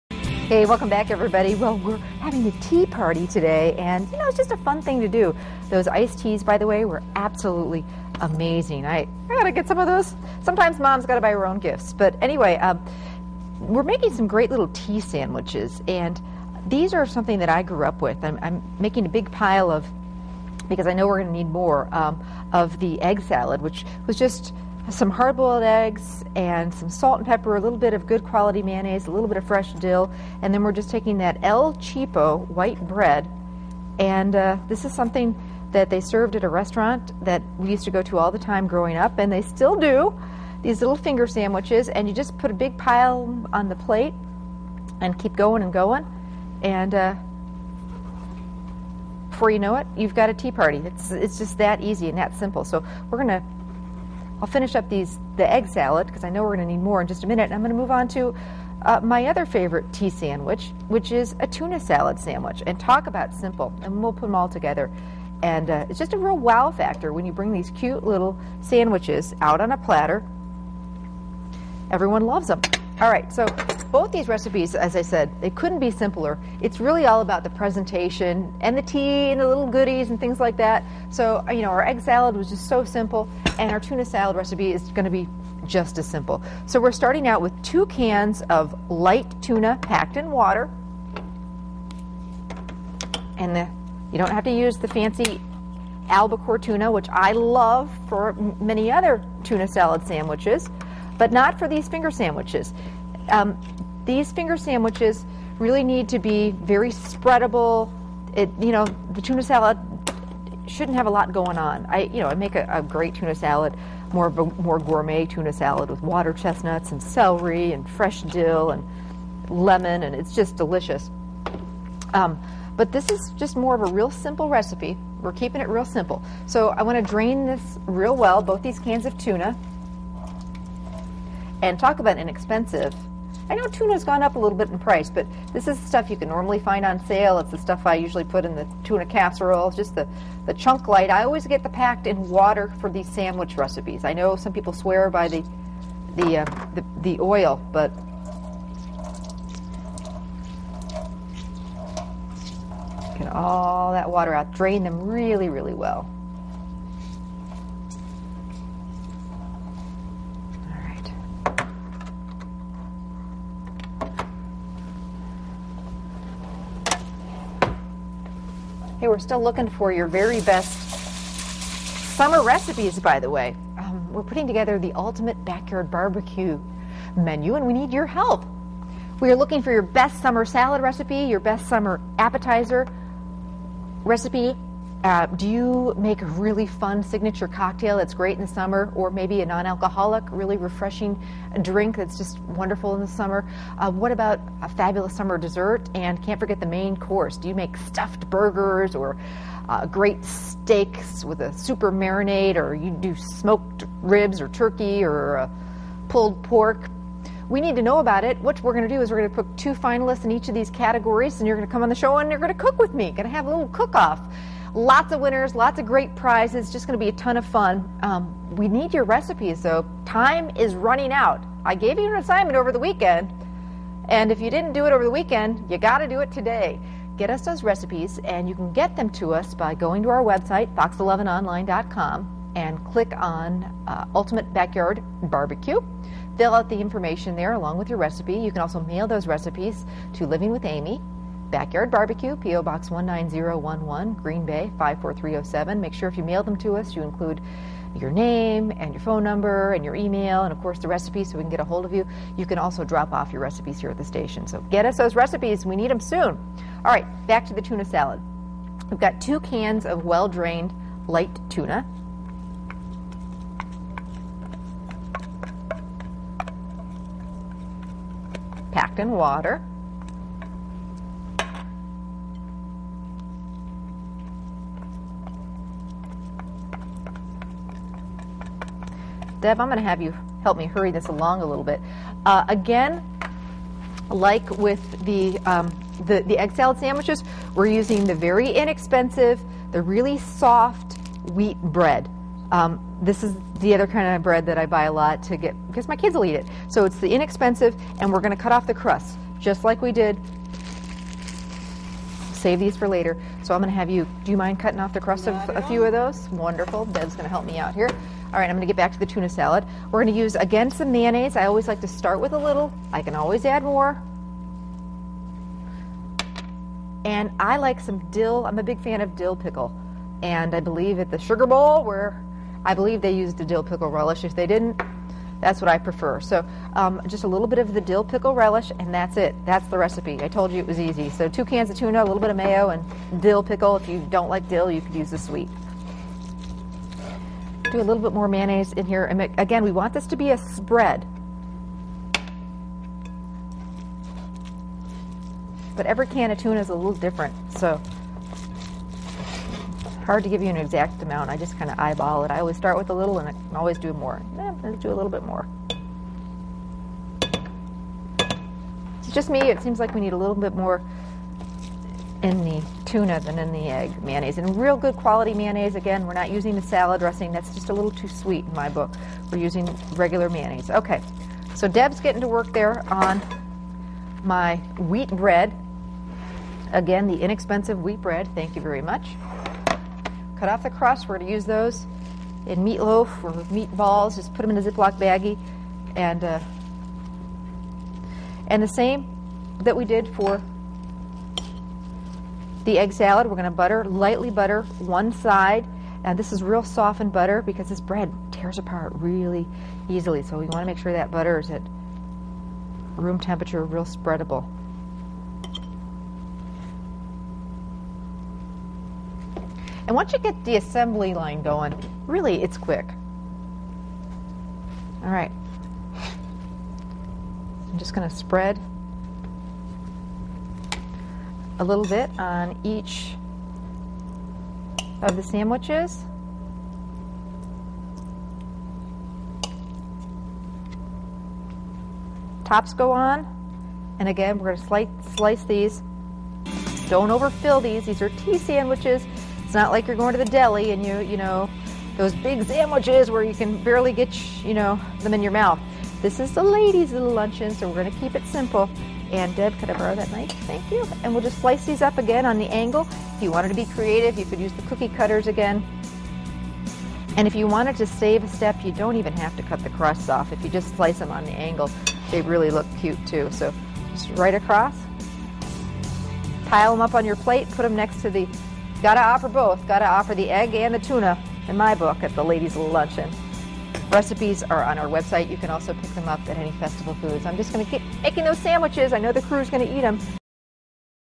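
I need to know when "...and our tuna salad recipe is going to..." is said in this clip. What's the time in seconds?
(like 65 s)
83 s.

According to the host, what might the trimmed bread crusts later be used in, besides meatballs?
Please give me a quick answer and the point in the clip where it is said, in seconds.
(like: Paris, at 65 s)
meatloaf, at 382 s.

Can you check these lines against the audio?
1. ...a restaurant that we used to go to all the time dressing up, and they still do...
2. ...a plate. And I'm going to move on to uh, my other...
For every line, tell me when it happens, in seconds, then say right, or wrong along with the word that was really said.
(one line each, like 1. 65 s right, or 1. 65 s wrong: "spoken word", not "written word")
1. 36 s wrong: "growing", not "dressing"
2. 57 s wrong: "minute", not "plate".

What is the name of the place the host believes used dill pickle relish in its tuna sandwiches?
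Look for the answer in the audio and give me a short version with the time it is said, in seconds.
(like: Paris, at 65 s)
Sugar Bowl, at 321 s.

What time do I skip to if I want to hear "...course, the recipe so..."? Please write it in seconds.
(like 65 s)
250 s.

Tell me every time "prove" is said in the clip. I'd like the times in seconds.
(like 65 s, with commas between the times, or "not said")
not said.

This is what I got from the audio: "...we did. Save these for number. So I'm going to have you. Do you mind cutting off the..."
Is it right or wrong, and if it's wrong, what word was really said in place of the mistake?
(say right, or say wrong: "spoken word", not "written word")
wrong: "later", not "number".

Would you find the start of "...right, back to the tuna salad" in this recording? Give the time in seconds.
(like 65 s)
256 s.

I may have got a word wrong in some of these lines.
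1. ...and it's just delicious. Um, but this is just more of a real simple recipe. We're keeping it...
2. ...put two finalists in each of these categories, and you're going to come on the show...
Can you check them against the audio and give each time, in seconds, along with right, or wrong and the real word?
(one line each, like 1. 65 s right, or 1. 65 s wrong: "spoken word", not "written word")
1. 120 s right
2. 209 s right.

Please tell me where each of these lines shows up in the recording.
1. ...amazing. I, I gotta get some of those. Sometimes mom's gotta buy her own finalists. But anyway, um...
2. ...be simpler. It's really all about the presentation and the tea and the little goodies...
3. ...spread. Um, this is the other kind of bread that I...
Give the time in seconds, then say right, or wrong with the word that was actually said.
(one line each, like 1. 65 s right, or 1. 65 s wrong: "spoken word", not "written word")
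1. 8 s wrong: "gifts", not "finalists"
2. 75 s right
3. 291 s wrong: "bread", not "spread".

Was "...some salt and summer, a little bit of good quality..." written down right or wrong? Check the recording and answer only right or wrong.
wrong.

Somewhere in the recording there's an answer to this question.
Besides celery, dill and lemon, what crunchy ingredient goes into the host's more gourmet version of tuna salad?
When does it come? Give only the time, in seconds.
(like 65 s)
116 s.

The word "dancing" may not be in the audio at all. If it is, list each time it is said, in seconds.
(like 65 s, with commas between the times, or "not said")
not said.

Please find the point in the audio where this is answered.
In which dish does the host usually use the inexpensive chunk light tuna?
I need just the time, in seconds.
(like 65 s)
138 s.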